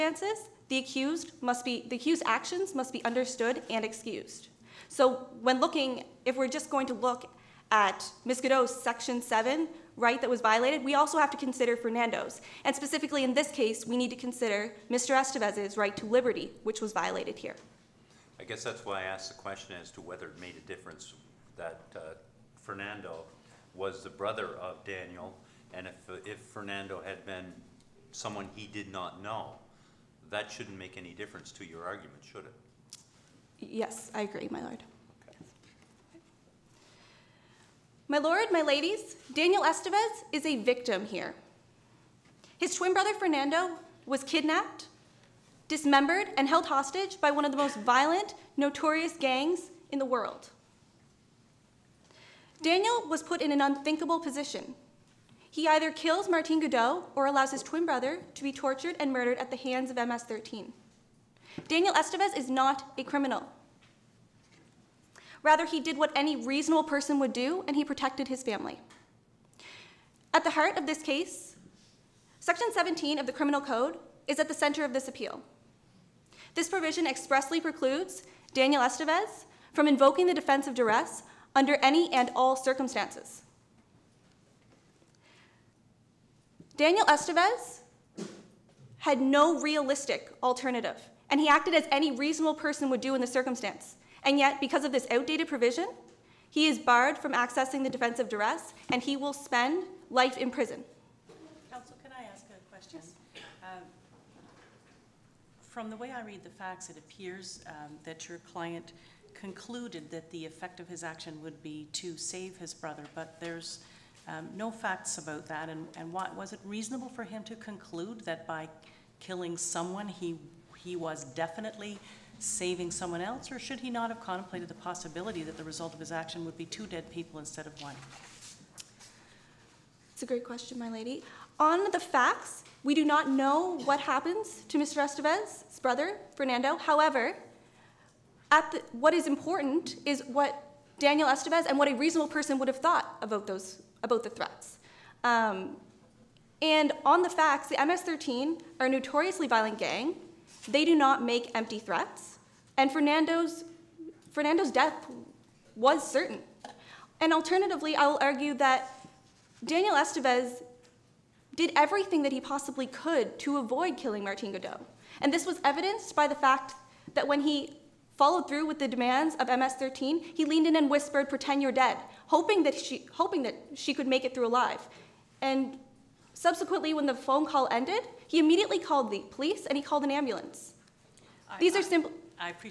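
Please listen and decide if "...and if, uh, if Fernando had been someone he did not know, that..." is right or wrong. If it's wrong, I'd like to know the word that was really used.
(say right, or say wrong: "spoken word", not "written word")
right.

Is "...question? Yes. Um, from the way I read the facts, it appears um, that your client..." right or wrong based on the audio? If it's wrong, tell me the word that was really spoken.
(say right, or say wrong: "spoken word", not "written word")
right.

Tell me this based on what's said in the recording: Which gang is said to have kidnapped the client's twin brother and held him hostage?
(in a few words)
MS-13.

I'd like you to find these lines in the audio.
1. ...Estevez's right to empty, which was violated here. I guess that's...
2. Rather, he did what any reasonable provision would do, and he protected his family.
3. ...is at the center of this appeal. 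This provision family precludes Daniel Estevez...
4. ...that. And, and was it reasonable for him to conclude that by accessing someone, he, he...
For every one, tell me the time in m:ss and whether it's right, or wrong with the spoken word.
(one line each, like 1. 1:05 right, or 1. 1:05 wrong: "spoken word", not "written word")
1. 0:15 wrong: "liberty", not "empty"
2. 1:05 wrong: "person", not "provision"
3. 1:14 wrong: "expressly", not "family"
4. 1:55 wrong: "killing", not "accessing".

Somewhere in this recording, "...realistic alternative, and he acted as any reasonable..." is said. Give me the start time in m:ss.
1:29.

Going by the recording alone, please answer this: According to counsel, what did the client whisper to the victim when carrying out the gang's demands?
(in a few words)
Pretend you're dead.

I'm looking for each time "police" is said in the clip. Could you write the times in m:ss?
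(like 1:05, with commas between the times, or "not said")
2:59.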